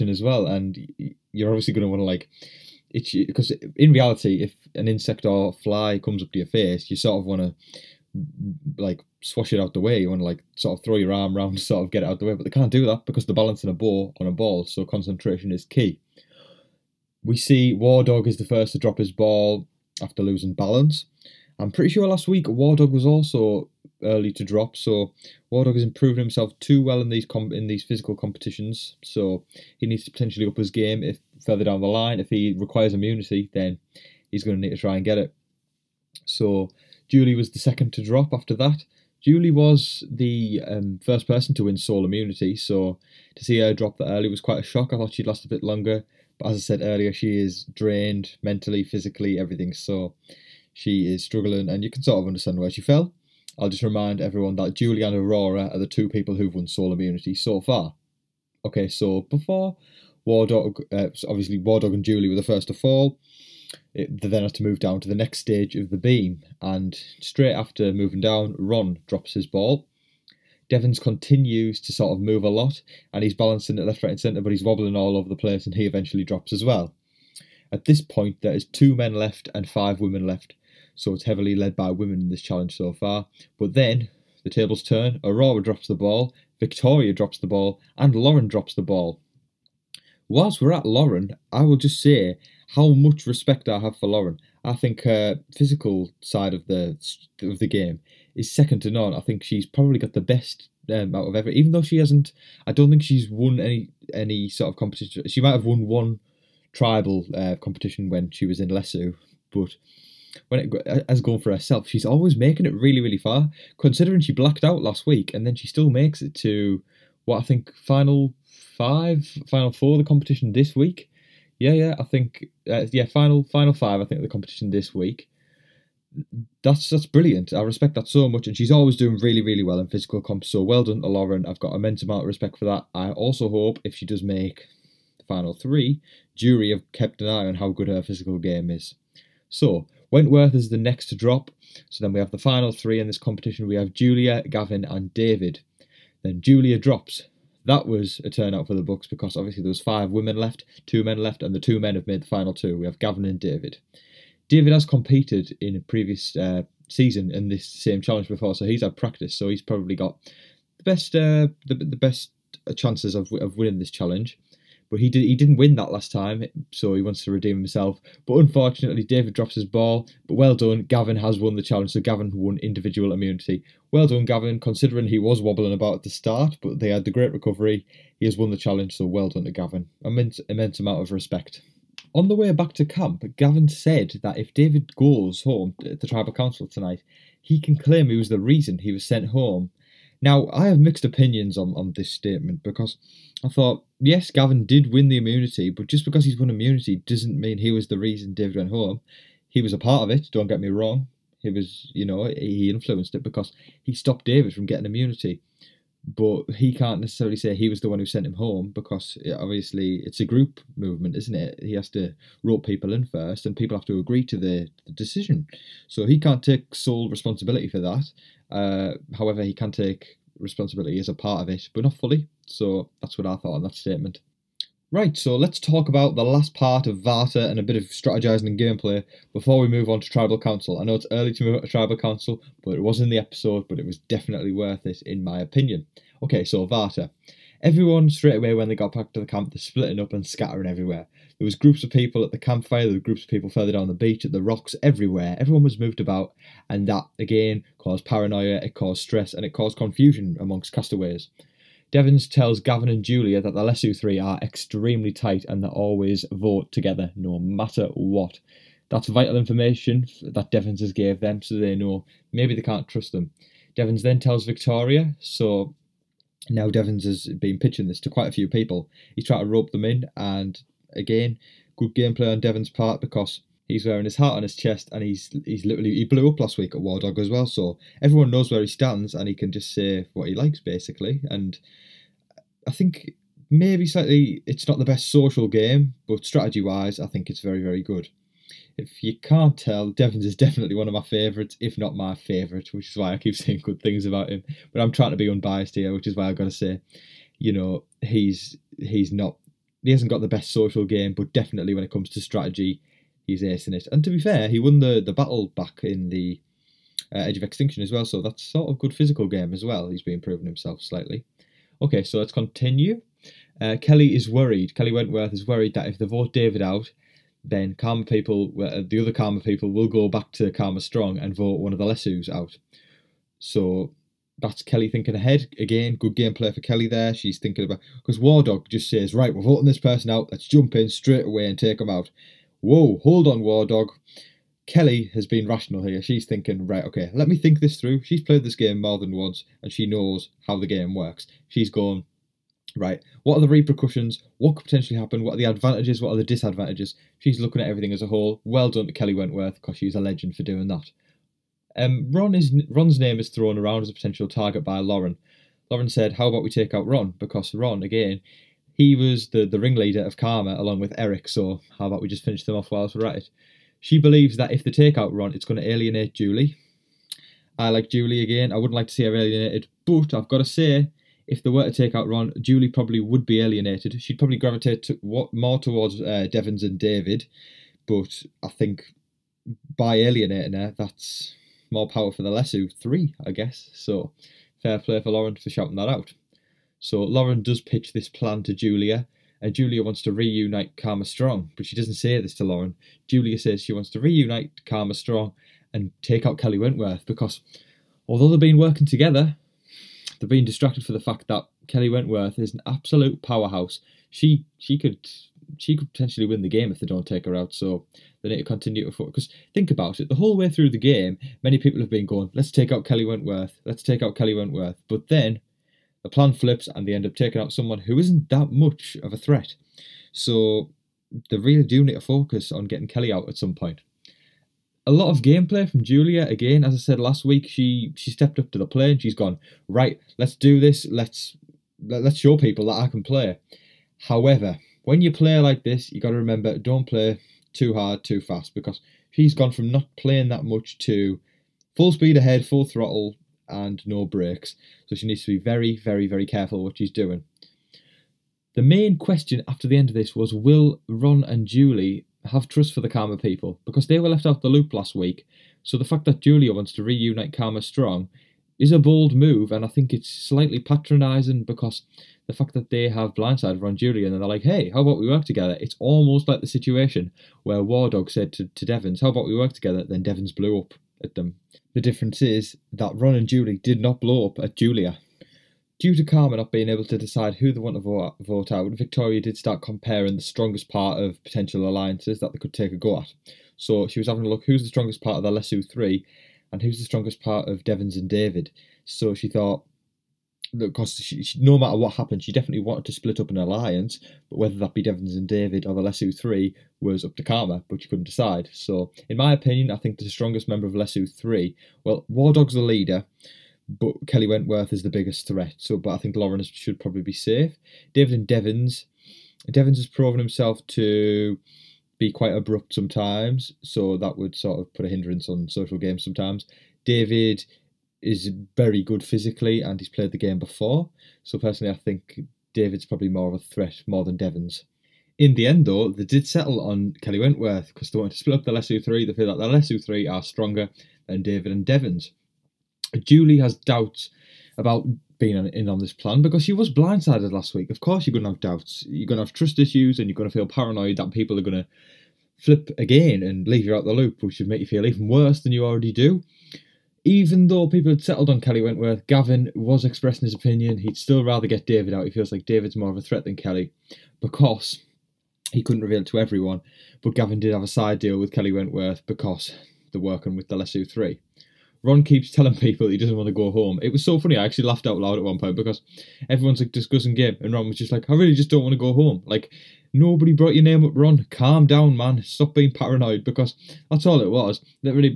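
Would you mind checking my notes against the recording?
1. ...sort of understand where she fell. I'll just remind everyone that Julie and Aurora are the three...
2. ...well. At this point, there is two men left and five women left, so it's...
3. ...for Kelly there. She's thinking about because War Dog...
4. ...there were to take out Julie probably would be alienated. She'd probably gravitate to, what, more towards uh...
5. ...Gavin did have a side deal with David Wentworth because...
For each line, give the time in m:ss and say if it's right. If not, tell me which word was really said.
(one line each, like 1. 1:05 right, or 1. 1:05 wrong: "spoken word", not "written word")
1. 0:52 wrong: "two", not "three"
2. 1:16 right
3. 5:26 right
4. 6:11 right
5. 9:17 wrong: "Kelley", not "David".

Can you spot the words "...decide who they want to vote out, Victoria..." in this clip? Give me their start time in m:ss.
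7:56.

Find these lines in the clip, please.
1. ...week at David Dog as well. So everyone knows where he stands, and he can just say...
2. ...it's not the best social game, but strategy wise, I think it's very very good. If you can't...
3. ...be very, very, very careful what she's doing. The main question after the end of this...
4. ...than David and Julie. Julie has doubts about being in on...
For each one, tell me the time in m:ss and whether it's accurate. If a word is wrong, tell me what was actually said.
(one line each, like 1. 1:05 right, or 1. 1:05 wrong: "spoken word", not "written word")
1. 4:36 wrong: "War", not "David"
2. 4:44 right
3. 7:25 right
4. 8:51 wrong: "Devens", not "Julie".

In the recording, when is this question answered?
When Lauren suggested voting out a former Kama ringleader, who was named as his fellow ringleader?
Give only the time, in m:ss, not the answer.
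6:00.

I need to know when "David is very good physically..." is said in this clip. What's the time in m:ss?
8:36.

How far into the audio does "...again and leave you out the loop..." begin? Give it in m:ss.
9:02.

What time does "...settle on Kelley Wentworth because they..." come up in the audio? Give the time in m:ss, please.
8:46.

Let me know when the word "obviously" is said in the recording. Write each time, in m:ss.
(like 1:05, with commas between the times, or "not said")
0:01, 1:01, 2:29, 3:29.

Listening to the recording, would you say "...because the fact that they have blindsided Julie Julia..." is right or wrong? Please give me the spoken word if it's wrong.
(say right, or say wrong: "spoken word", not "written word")
wrong: "Ron", not "Julie".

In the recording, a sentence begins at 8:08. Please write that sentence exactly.
So she thought, because she, she, no matter what happened, she definitely wanted to split up an alliance.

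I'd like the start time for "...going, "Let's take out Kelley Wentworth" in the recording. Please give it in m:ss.
6:52.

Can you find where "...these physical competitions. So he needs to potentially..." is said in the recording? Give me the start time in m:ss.
0:27.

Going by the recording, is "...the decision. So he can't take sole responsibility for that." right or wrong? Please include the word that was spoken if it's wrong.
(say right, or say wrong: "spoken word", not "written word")
right.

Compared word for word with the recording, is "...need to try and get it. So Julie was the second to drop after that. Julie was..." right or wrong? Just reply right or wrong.
right.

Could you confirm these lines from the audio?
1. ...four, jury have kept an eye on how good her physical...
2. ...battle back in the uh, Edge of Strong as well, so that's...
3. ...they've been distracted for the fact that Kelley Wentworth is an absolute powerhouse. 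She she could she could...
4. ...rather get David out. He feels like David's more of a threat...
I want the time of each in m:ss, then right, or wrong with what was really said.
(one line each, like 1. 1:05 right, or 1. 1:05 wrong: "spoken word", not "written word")
1. 2:15 wrong: "three", not "four"
2. 5:05 wrong: "Extinction", not "Strong"
3. 6:40 right
4. 9:11 right.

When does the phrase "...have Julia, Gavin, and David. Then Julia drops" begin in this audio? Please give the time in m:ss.
2:23.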